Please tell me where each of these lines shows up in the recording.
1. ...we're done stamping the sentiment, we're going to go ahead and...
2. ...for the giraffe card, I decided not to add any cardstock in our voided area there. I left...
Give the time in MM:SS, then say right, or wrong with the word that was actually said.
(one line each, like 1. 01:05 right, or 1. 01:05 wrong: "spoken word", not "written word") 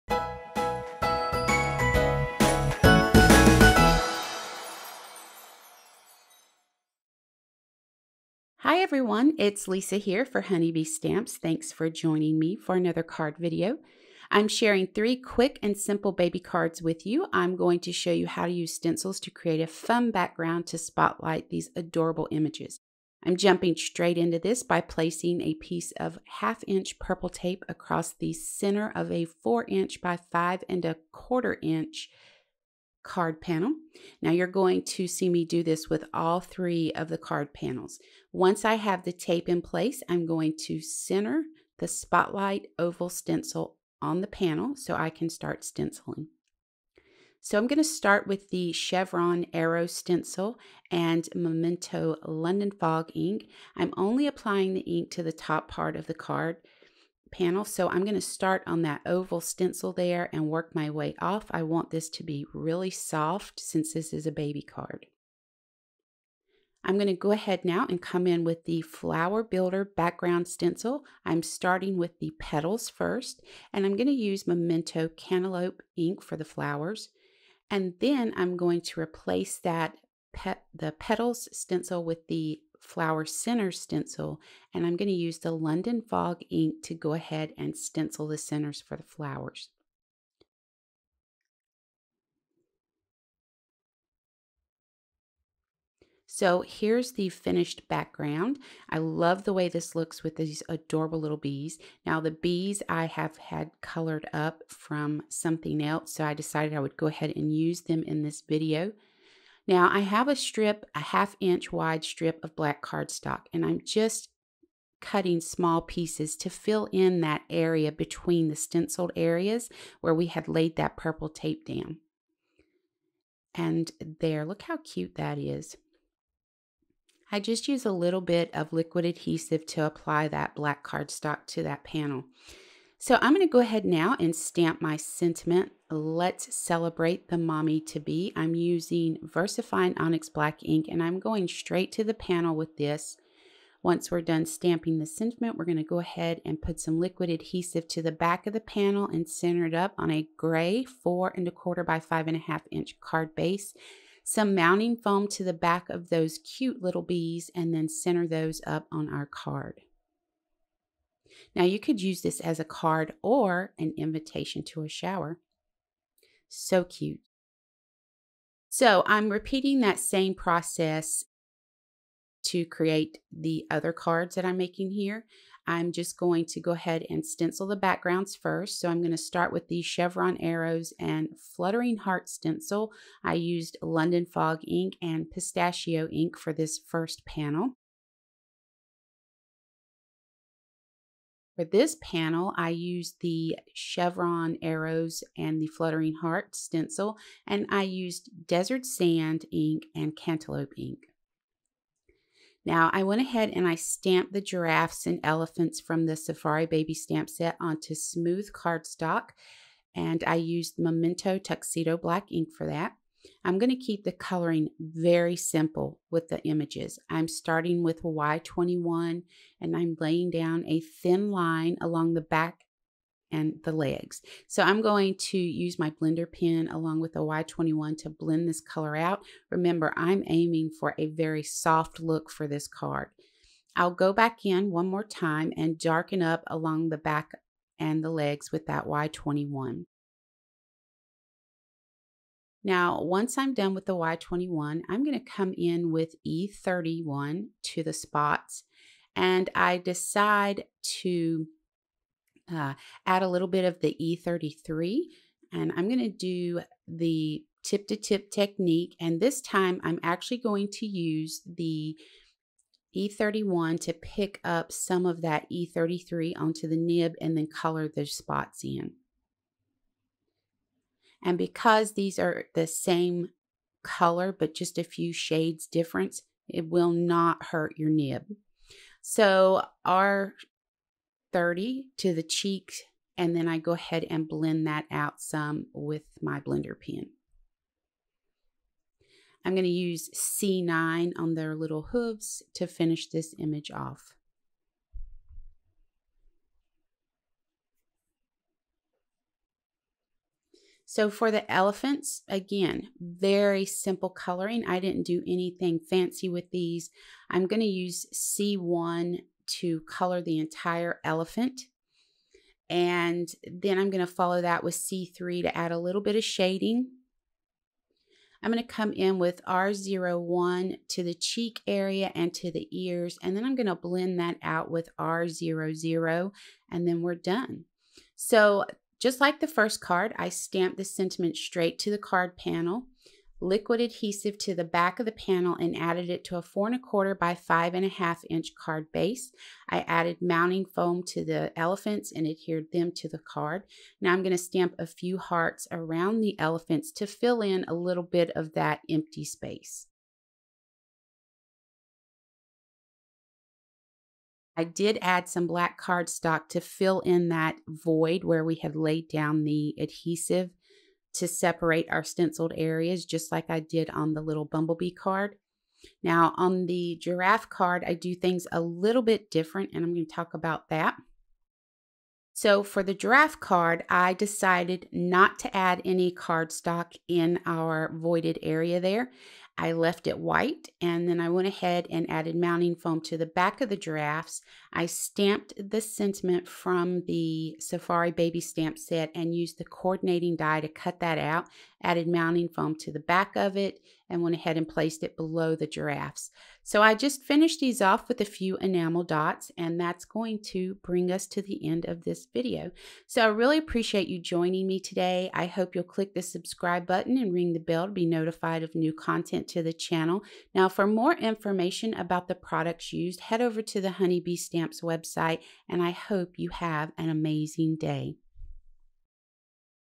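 1. 02:24 right
2. 06:12 right.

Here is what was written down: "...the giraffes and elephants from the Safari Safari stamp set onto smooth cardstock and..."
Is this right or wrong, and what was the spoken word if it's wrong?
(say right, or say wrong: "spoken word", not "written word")
wrong: "Baby", not "Safari".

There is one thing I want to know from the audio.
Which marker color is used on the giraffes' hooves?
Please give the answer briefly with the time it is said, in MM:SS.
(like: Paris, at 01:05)
C9, at 04:50.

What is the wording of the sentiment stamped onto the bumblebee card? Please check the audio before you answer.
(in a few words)
Let's celebrate the mommy to be.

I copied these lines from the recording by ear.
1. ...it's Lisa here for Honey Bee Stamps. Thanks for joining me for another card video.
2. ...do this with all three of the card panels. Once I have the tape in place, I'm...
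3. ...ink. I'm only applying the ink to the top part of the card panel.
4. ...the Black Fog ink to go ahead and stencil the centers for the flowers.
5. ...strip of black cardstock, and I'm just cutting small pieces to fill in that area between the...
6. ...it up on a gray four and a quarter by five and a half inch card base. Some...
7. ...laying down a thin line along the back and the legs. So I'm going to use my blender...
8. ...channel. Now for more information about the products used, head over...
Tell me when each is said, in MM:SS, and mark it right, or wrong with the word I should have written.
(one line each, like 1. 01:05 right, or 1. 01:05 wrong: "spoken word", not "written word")
1. 00:09 right
2. 00:35 right
3. 00:53 right
4. 01:25 wrong: "London", not "Black"
5. 01:52 right
6. 02:29 right
7. 03:39 right
8. 06:49 right.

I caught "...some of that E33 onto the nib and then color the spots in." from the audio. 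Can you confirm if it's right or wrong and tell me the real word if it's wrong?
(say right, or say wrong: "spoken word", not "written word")
right.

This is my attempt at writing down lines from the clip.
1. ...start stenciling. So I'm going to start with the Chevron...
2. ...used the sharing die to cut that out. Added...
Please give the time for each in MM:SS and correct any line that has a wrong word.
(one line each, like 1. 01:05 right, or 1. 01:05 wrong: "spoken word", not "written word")
1. 00:45 right
2. 06:29 wrong: "coordinating", not "sharing".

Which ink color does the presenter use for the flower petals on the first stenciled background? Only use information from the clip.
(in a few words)
Memento Cantaloupe.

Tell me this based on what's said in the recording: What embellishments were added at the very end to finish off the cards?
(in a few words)
enamel dots.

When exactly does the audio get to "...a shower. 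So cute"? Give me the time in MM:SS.
02:44.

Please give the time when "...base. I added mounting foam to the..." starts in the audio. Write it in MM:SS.
05:38.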